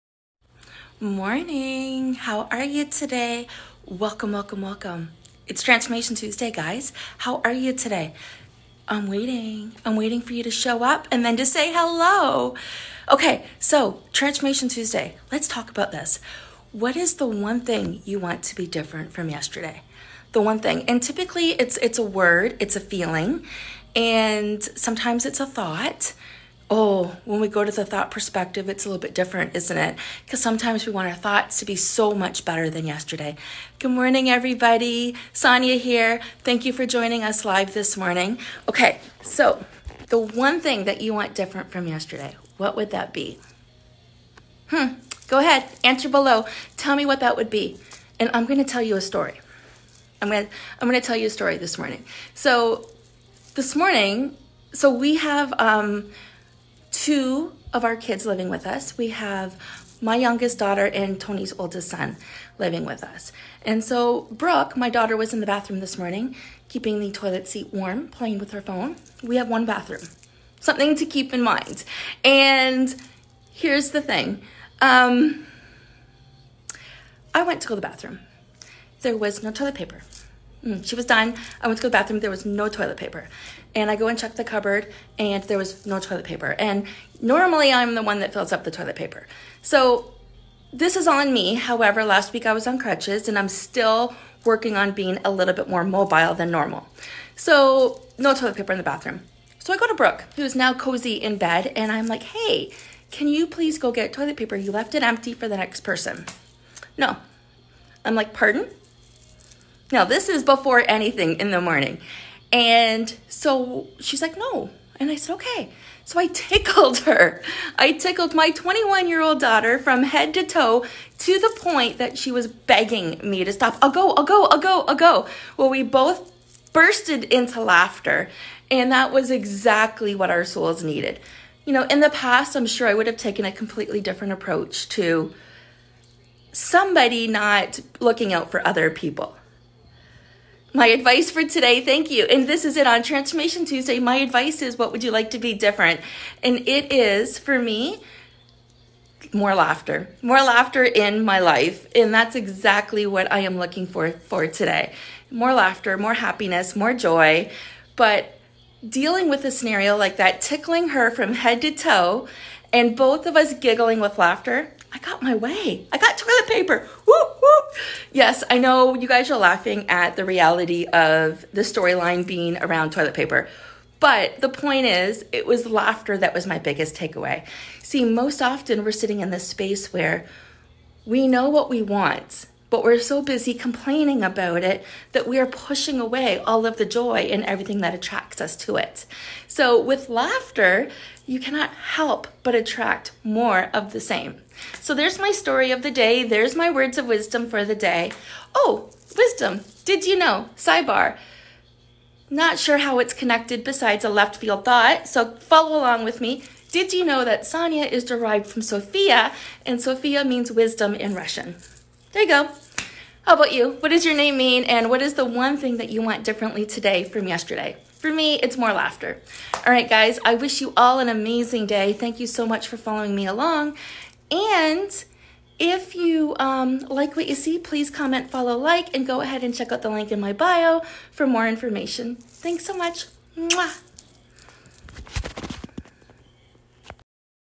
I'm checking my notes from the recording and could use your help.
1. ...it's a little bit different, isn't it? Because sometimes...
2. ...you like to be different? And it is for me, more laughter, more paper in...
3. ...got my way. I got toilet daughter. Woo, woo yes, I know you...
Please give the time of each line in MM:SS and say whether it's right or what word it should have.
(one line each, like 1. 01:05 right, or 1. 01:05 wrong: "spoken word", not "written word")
1. 00:28 right
2. 02:25 wrong: "laughter", not "paper"
3. 02:44 wrong: "paper", not "daughter".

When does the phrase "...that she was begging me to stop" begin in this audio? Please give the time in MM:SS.
02:01.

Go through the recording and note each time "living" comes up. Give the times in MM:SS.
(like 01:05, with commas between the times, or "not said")
00:58, 01:02.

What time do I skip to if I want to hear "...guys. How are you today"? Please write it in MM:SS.
00:06.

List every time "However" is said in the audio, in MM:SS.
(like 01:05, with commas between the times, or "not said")
01:31.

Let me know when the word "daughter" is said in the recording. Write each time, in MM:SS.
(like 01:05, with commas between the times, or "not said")
01:00, 01:04, 01:59.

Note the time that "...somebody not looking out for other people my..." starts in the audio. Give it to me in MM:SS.
02:16.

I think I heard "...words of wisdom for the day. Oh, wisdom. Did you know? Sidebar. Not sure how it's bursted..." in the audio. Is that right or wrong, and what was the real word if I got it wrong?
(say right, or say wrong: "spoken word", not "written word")
wrong: "connected", not "bursted".